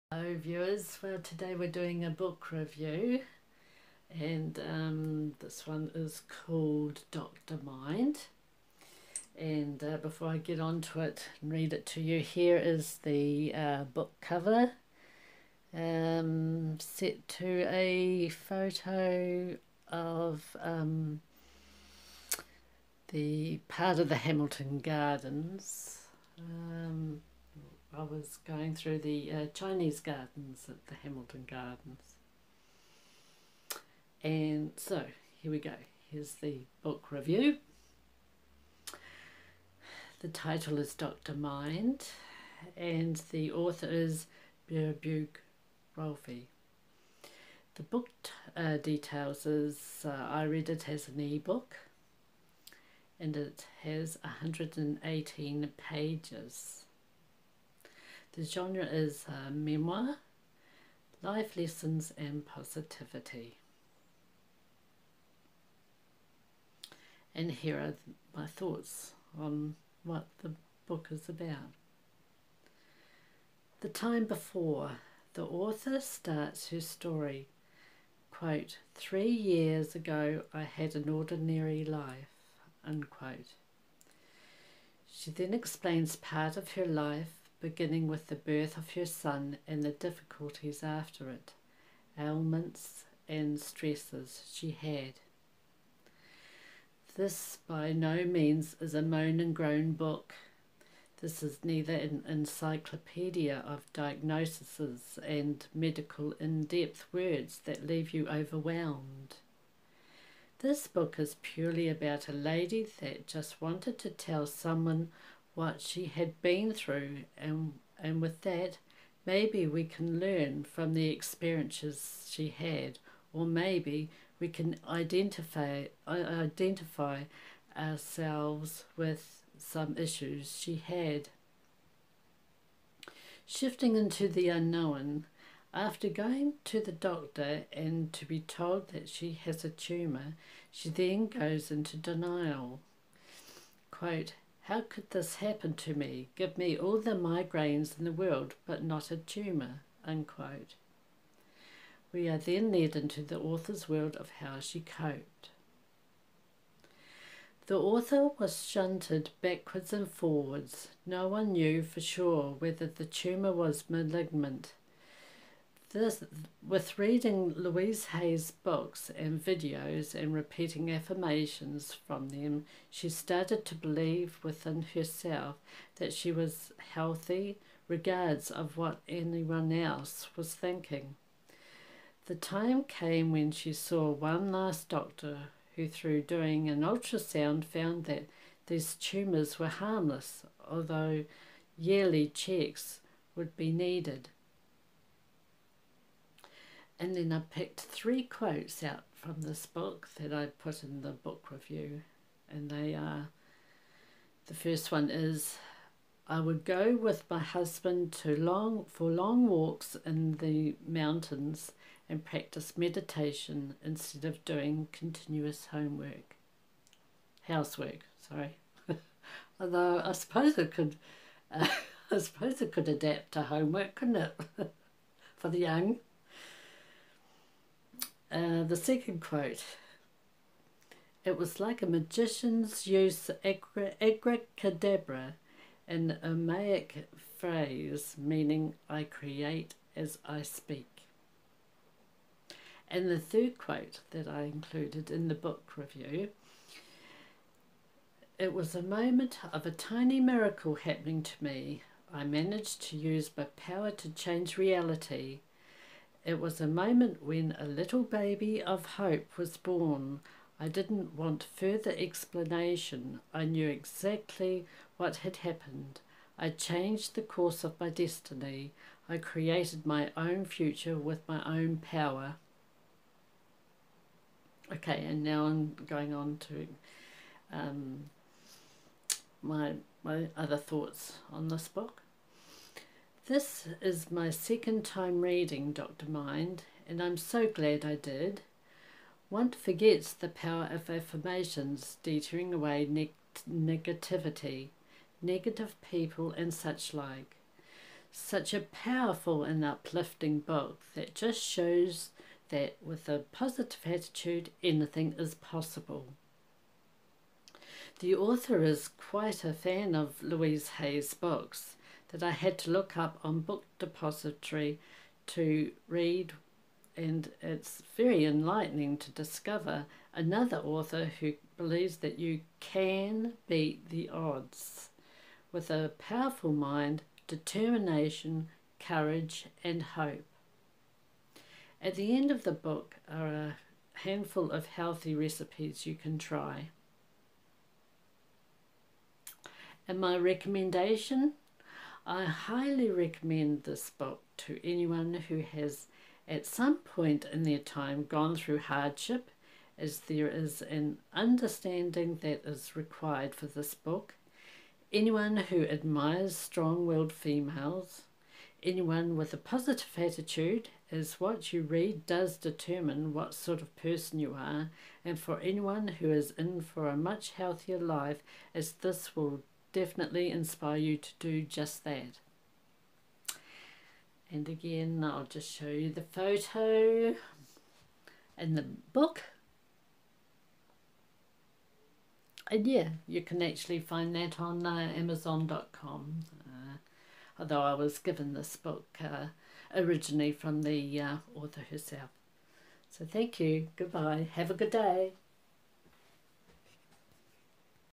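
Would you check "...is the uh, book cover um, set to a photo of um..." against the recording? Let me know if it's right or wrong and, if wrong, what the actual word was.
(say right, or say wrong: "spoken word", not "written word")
right.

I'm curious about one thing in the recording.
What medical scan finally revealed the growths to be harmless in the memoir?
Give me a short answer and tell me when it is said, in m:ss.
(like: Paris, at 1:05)
Ultrasound, at 3:06.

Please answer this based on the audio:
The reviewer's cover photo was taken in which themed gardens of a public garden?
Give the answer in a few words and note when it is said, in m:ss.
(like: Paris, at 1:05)
Chinese gardens, at 0:29.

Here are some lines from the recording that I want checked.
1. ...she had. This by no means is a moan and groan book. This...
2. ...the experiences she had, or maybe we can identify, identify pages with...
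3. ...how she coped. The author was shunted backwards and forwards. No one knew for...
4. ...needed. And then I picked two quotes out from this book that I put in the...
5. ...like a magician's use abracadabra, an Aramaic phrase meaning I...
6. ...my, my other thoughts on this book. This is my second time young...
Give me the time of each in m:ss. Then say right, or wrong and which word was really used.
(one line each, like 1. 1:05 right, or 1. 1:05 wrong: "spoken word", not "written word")
1. 1:34 right
2. 2:00 wrong: "ourselves", not "pages"
3. 2:34 right
4. 3:13 wrong: "three", not "two"
5. 3:51 right
6. 4:39 wrong: "reading", not "young".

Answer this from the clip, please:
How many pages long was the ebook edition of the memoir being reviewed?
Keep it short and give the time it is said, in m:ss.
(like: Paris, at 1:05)
118, at 0:54.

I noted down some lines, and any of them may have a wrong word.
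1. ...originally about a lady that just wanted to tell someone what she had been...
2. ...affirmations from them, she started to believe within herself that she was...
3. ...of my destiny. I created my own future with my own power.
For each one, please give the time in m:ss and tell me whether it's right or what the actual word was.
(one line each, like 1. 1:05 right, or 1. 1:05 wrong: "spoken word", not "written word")
1. 1:51 wrong: "purely", not "originally"
2. 2:50 right
3. 4:27 right.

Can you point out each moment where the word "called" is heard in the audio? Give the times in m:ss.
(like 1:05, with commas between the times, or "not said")
0:06.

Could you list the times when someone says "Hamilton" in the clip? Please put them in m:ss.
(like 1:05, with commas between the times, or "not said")
0:24, 0:31.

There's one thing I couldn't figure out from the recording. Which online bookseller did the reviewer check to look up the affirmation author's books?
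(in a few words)
Book Depository.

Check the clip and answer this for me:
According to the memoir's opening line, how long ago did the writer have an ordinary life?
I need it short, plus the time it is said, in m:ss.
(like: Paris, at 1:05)
3 years ago, at 1:18.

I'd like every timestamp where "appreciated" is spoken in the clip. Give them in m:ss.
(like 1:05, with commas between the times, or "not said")
not said.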